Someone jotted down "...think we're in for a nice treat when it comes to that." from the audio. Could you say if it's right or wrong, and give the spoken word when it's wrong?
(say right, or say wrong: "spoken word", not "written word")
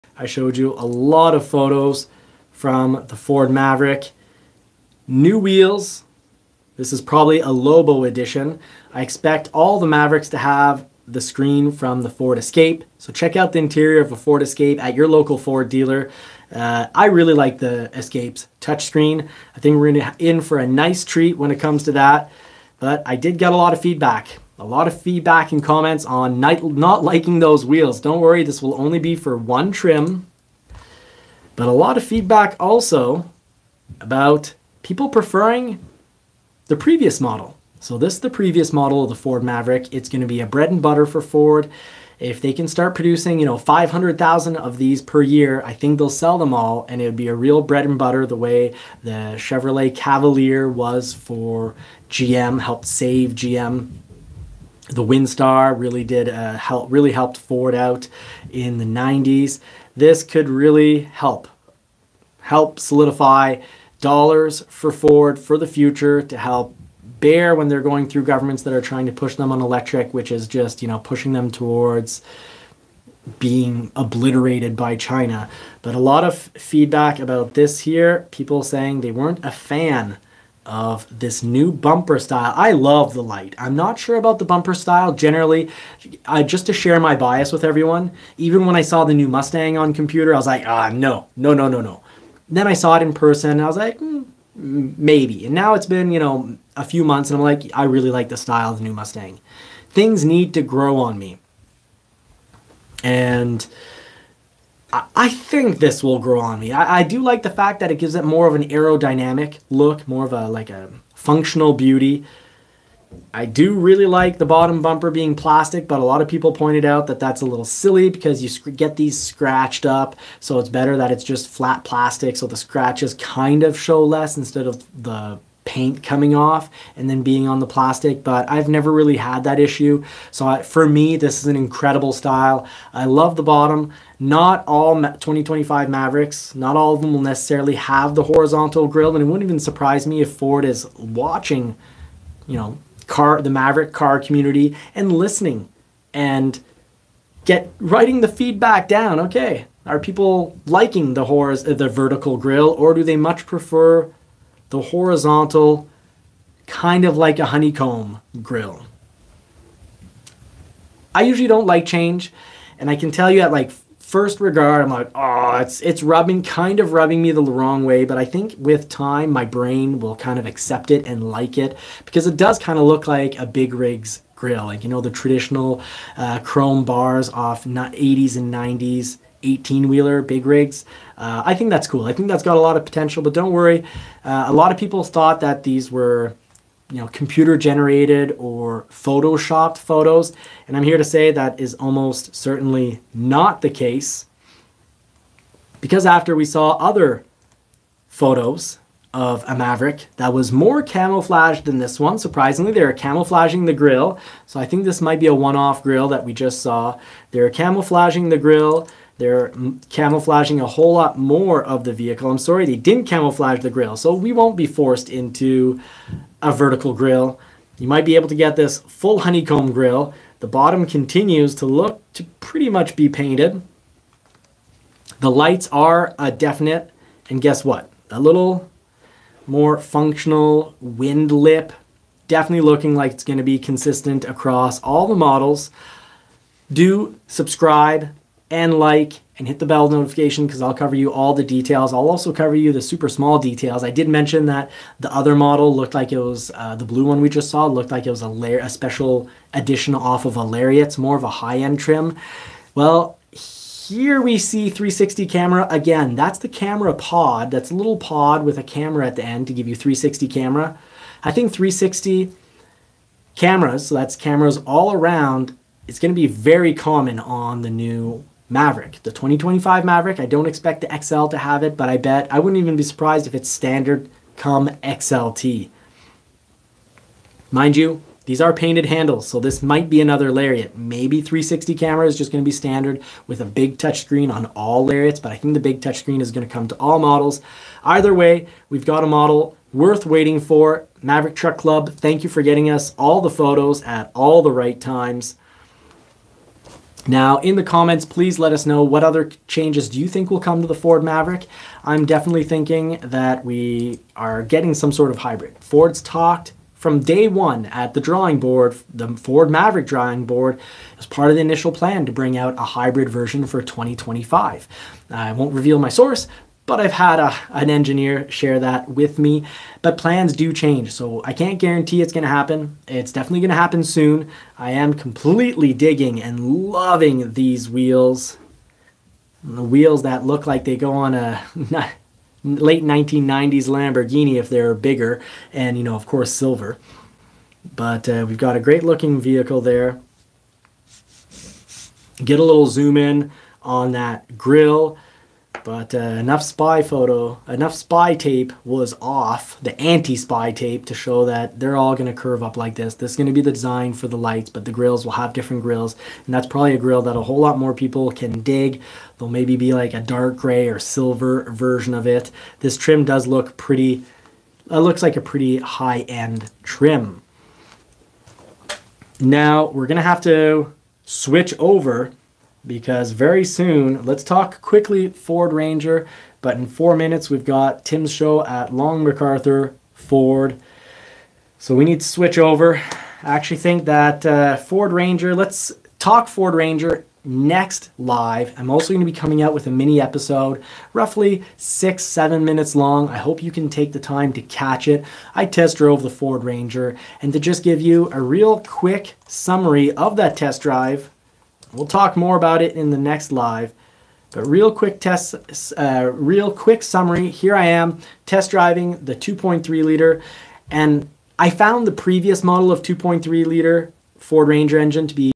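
right.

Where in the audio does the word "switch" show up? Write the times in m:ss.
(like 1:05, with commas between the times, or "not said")
6:11, 6:22.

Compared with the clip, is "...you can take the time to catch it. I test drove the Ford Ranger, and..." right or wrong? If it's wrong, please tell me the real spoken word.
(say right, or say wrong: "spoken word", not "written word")
right.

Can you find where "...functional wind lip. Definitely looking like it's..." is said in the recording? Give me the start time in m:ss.
3:49.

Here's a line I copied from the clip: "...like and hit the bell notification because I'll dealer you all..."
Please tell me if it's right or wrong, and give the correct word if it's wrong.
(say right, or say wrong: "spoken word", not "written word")
wrong: "cover", not "dealer".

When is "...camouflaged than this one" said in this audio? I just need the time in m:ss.
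3:20.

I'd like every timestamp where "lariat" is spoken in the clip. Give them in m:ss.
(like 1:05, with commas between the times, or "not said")
4:10, 4:40, 4:44.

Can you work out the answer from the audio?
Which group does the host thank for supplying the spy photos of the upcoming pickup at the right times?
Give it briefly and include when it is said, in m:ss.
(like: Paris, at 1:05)
Maverick Truck Club, at 4:51.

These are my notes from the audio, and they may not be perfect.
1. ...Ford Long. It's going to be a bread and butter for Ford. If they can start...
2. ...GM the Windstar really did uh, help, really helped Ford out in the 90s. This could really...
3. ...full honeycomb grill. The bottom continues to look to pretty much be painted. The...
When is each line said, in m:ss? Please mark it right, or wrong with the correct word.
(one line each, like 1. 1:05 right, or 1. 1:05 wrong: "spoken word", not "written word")
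1. 0:39 wrong: "Maverick", not "Long"
2. 0:53 right
3. 3:38 right.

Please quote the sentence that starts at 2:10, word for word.
So I, for me, this is an incredible style.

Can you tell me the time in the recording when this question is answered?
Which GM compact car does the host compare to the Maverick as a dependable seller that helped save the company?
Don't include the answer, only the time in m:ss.
0:49.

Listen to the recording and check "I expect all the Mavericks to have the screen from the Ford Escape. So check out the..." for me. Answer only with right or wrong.
right.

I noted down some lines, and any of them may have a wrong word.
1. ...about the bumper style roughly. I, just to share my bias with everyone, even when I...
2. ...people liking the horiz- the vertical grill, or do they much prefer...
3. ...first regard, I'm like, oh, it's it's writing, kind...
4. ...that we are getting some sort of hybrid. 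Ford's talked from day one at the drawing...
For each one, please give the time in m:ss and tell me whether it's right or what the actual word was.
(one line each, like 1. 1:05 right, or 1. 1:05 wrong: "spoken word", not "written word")
1. 1:24 wrong: "generally", not "roughly"
2. 2:29 right
3. 2:43 wrong: "rubbing", not "writing"
4. 5:03 right.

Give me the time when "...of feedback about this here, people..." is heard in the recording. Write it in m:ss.
1:16.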